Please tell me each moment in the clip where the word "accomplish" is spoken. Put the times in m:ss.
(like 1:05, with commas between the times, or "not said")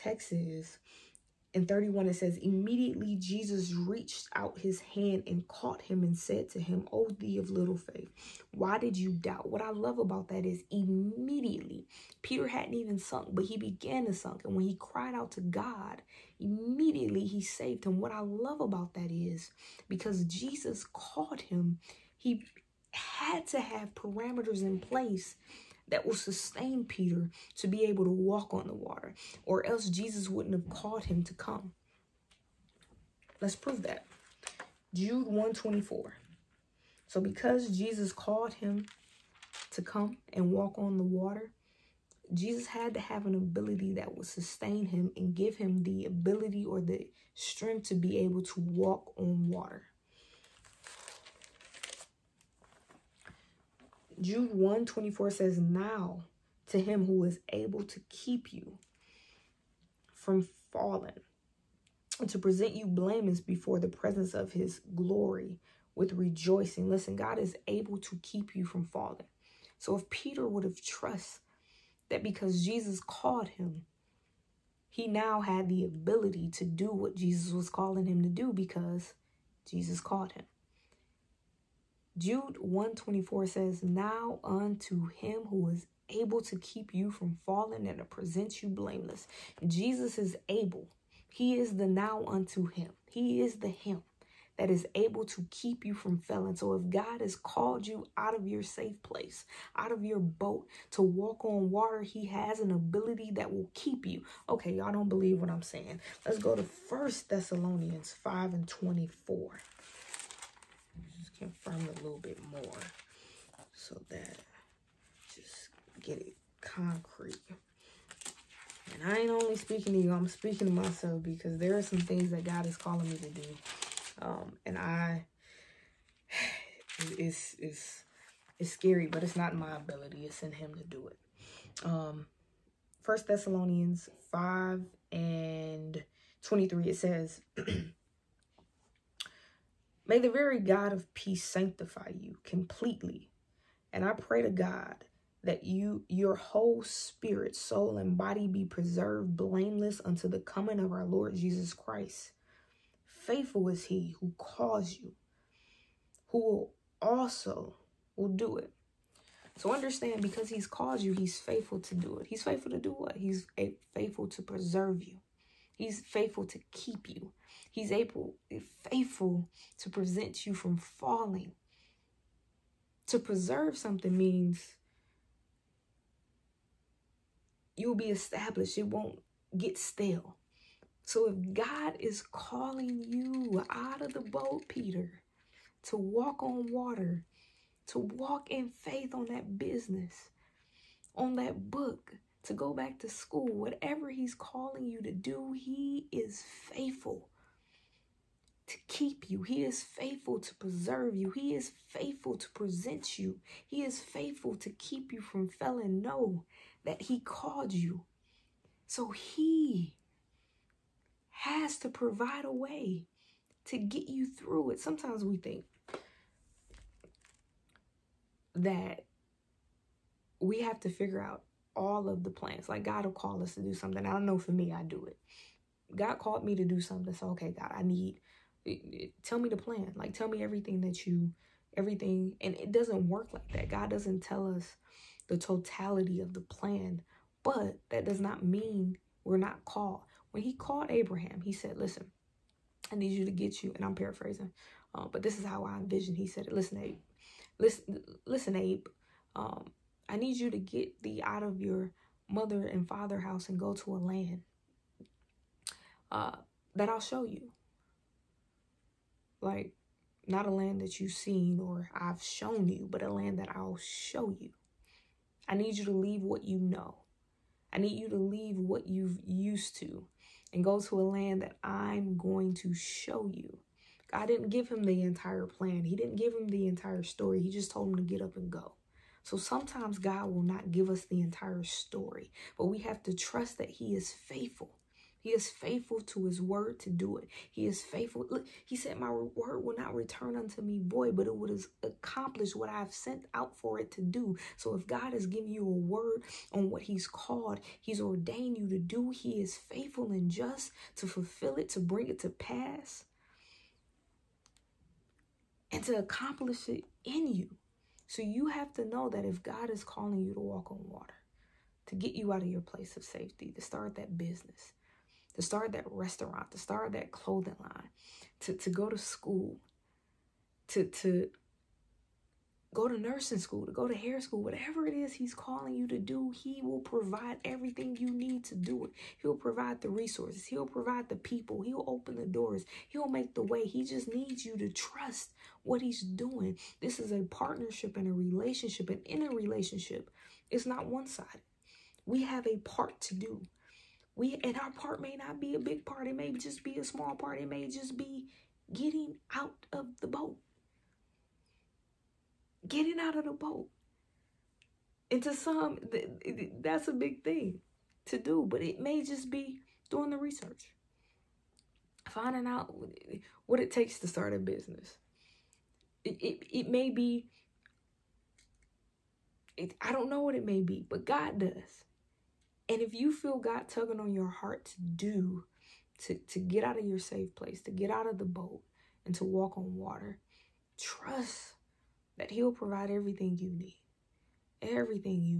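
4:51, 5:05.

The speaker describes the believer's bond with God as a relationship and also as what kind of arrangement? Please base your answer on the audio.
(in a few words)
A partnership.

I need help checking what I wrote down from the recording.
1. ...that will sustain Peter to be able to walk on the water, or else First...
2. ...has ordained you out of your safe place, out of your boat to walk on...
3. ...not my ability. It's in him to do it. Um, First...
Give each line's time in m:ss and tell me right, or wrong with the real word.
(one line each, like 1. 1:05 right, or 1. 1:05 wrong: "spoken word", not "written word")
1. 0:25 wrong: "Jesus", not "First"
2. 1:37 wrong: "called", not "ordained"
3. 2:09 right.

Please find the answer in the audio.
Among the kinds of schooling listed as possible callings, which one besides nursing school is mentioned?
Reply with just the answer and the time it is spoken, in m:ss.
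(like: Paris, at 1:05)
Hair school, at 5:23.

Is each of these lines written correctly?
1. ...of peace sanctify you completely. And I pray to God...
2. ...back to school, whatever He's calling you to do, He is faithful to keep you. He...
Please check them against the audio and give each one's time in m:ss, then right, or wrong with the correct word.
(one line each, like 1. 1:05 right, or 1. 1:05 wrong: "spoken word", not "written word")
1. 2:20 right
2. 3:12 right.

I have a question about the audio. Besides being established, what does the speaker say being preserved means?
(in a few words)
It won't get stale.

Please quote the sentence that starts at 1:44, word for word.
Okay, y'all don't believe what I'm saying.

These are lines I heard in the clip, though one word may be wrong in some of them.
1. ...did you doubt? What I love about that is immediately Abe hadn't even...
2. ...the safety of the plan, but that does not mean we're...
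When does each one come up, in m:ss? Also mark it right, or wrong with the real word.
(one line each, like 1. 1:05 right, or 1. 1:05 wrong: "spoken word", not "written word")
1. 0:08 wrong: "Peter", not "Abe"
2. 3:55 wrong: "totality", not "safety".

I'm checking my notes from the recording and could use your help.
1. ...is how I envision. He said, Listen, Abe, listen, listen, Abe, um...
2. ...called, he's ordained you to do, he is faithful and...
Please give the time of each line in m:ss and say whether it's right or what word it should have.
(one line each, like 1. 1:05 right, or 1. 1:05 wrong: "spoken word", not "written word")
1. 4:05 right
2. 4:57 right.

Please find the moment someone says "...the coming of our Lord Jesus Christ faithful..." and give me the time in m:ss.
2:30.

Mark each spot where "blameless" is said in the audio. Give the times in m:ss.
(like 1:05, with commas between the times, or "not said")
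1:02, 1:28, 2:29.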